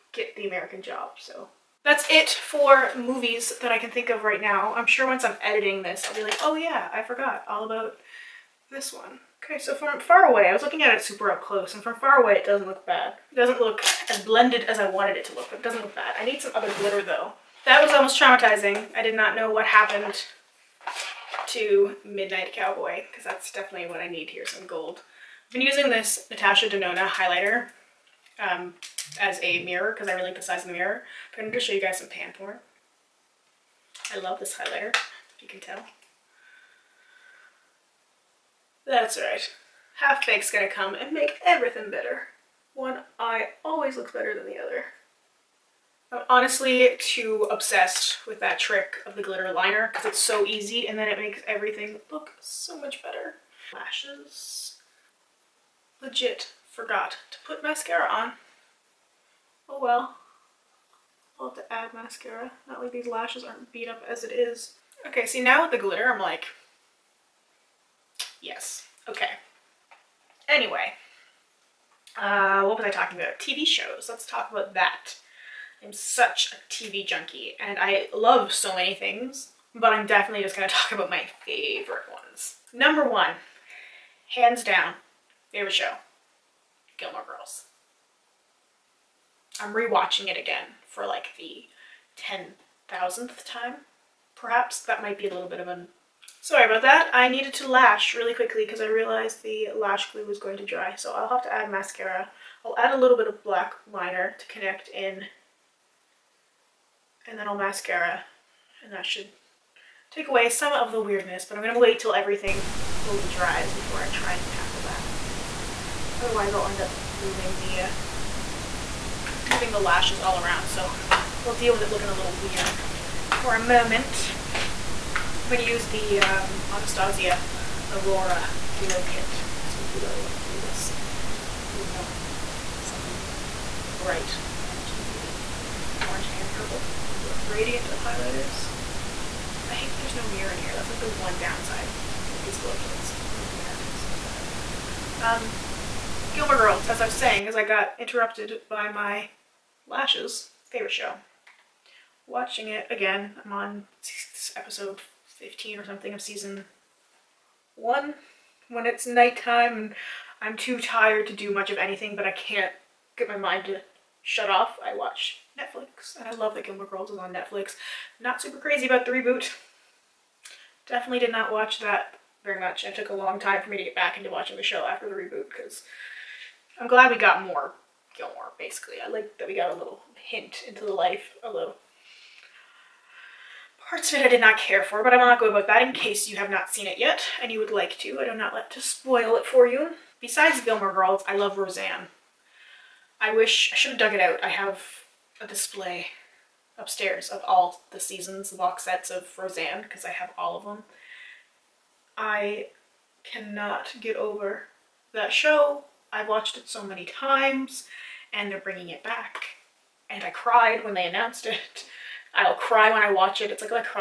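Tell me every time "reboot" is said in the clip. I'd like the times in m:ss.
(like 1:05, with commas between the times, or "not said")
2:49, 2:55.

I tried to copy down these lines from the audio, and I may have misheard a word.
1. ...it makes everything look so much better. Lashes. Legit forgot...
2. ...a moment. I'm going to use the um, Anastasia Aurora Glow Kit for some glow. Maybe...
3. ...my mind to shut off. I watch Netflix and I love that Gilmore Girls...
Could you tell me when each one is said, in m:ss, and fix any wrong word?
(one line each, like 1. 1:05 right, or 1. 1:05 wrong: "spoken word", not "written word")
1. 0:51 right
2. 2:03 right
3. 2:43 right.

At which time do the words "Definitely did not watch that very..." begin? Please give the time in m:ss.
2:50.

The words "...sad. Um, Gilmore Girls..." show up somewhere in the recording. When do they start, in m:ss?
2:24.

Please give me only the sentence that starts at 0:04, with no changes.
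I'm sure once I'm editing this, I'll be like, oh yeah, I forgot all about this one.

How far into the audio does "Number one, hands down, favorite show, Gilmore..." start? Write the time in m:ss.
1:22.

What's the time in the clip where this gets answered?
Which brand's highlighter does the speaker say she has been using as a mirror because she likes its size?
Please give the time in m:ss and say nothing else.
0:26.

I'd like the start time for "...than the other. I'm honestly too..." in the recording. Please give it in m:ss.
0:44.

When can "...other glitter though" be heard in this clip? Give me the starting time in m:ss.
0:16.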